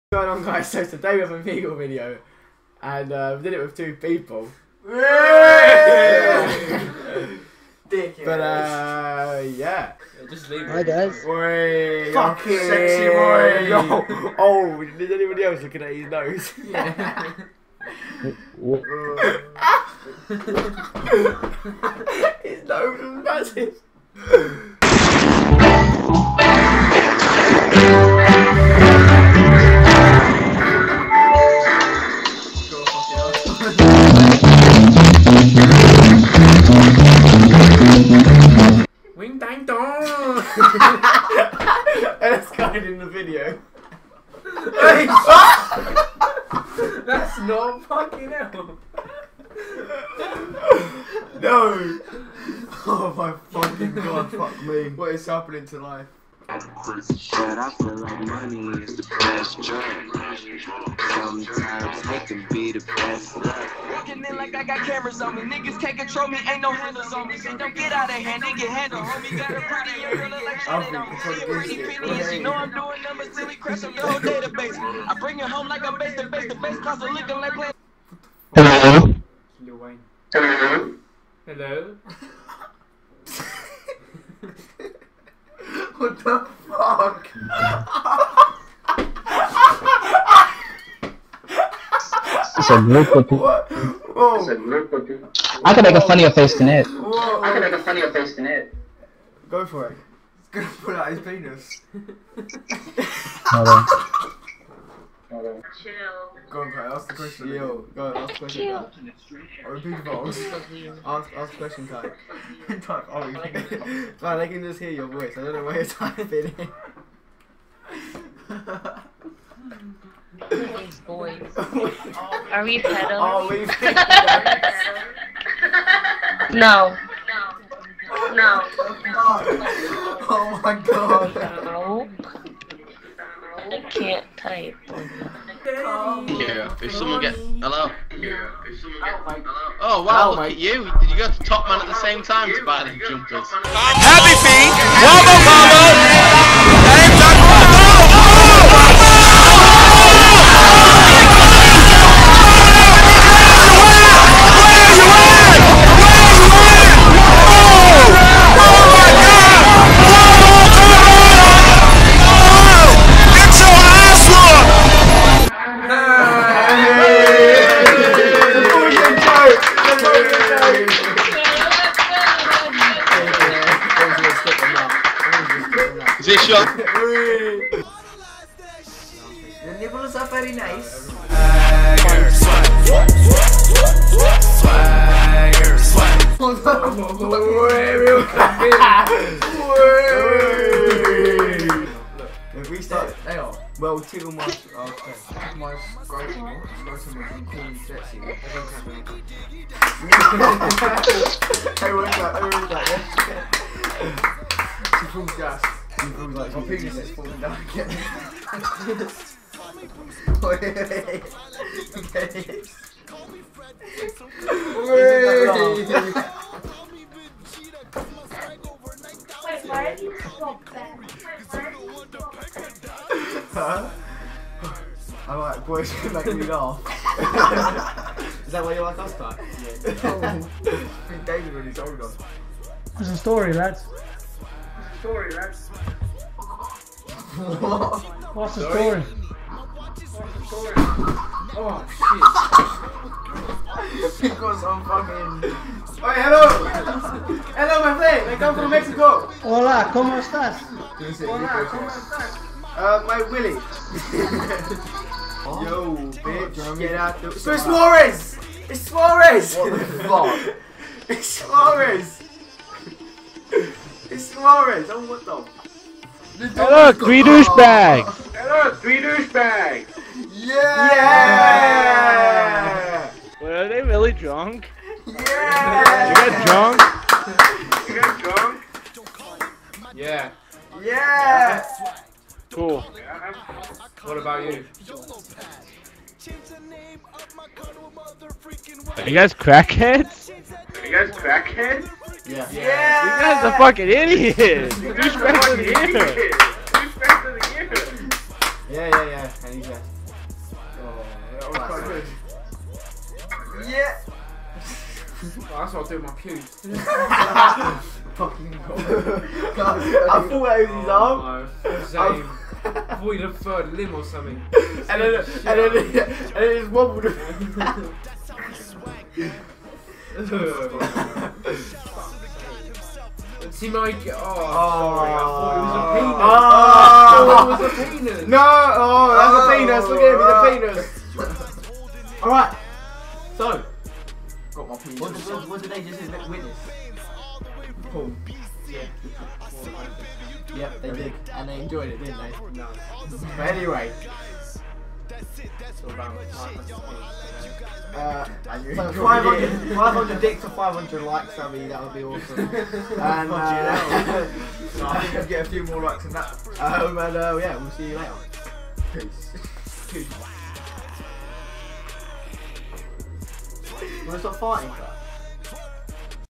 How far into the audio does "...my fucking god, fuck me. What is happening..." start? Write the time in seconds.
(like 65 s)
53 s.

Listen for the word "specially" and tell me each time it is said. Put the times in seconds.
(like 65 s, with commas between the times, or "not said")
not said.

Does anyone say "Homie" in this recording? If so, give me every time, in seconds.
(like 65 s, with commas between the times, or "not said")
69 s.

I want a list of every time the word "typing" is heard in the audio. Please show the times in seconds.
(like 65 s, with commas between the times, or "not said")
115 s.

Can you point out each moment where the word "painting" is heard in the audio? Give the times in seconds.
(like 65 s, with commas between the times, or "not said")
not said.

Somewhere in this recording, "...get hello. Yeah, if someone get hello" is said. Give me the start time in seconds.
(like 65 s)
137 s.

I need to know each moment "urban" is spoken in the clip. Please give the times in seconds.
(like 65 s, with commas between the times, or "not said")
not said.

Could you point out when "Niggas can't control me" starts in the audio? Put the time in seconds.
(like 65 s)
65 s.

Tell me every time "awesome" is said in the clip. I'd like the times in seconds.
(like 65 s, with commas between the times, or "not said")
352 s.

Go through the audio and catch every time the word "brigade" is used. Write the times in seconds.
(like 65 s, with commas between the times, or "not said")
not said.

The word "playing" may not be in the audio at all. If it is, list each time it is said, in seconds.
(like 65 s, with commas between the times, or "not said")
77 s.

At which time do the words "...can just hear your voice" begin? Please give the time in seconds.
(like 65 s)
114 s.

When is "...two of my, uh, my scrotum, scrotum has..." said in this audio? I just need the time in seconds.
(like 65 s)
193 s.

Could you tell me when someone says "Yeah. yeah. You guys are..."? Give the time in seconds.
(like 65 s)
292 s.